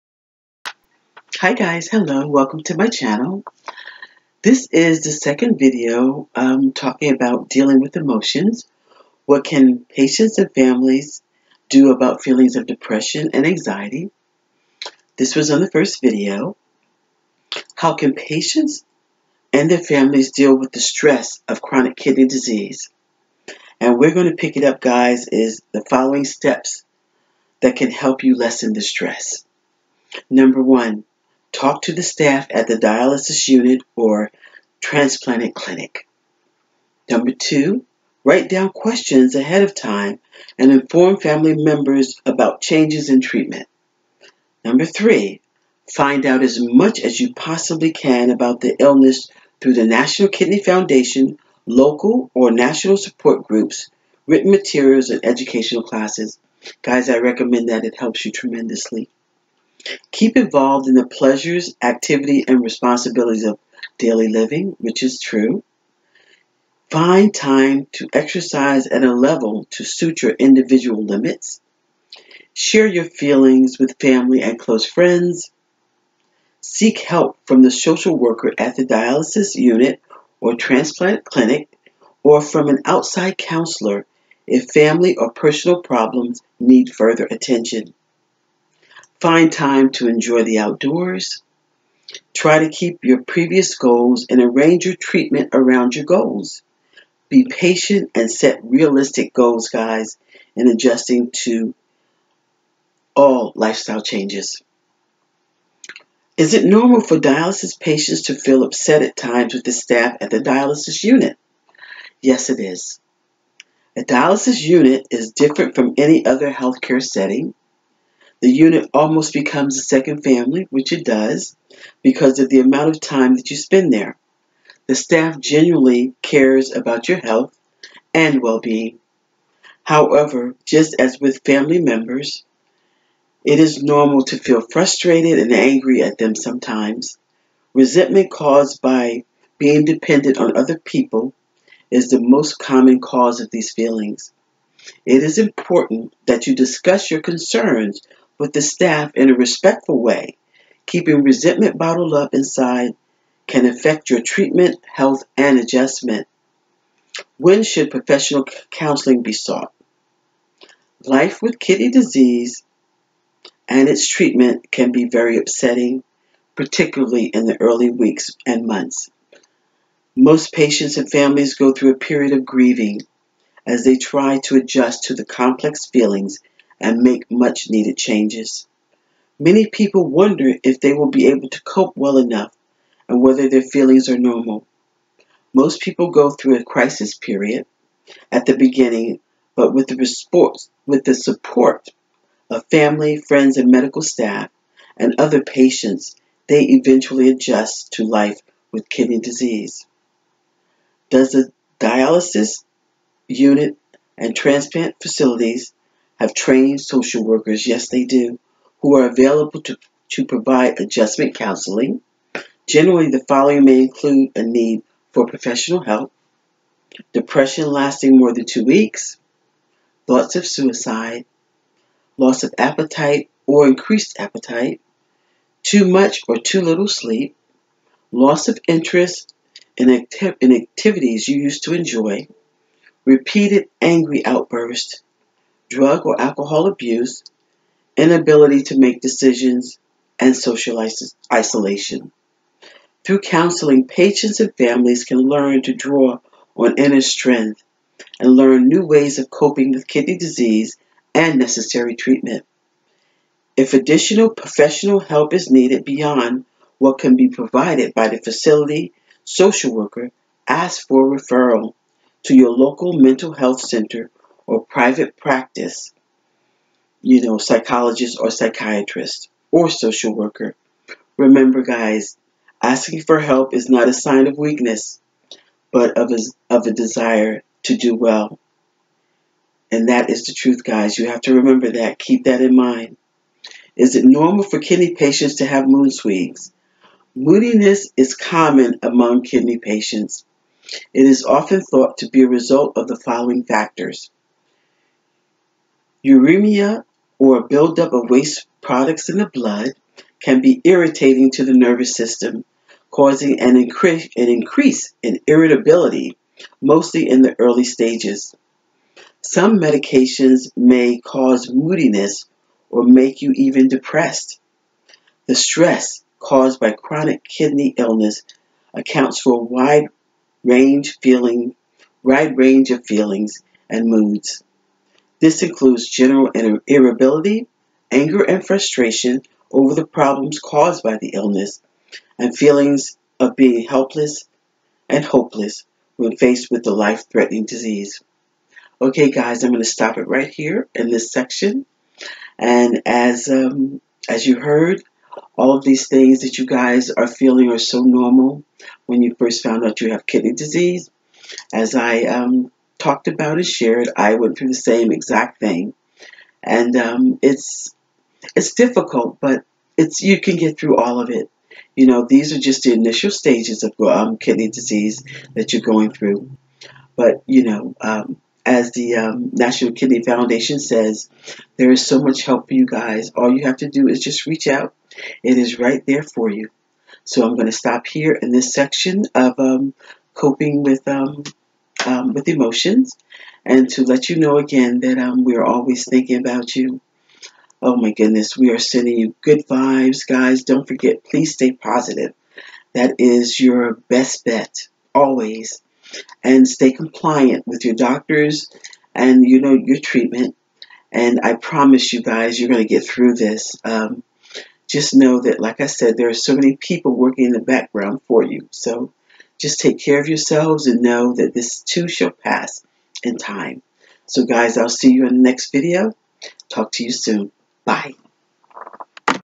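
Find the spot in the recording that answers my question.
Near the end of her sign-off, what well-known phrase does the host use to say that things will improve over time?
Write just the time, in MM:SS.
06:51.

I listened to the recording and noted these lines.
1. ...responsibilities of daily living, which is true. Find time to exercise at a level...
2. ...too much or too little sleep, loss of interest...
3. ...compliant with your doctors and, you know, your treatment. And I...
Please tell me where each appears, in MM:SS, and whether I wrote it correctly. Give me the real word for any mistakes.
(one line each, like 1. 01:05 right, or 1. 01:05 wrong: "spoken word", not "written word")
1. 01:02 right
2. 03:45 right
3. 06:36 right.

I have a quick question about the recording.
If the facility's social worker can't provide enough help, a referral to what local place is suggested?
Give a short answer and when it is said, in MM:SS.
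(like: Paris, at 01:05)
local mental health center, at 04:22.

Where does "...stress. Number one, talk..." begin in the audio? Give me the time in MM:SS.
00:28.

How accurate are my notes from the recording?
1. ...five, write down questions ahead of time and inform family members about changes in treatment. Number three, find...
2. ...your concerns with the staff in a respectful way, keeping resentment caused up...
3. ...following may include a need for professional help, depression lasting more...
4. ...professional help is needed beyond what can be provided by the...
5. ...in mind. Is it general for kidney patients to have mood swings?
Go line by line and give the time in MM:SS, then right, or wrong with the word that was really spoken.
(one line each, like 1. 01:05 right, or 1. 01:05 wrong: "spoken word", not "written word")
1. 00:37 wrong: "two", not "five"
2. 02:27 wrong: "bottled", not "caused"
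3. 03:33 right
4. 04:14 right
5. 04:42 wrong: "normal", not "general".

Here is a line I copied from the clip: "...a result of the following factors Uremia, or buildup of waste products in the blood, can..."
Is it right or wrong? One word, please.
right.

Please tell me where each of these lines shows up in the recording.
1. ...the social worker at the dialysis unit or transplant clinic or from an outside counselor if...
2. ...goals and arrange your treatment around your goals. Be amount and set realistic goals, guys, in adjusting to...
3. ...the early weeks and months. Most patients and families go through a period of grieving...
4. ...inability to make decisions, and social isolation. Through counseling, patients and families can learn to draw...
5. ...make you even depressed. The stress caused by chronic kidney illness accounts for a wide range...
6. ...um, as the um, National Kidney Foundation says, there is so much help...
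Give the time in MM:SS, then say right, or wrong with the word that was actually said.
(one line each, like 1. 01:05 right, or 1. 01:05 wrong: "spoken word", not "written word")
1. 01:17 right
2. 01:33 wrong: "patient", not "amount"
3. 02:47 right
4. 03:57 right
5. 05:12 right
6. 06:07 right.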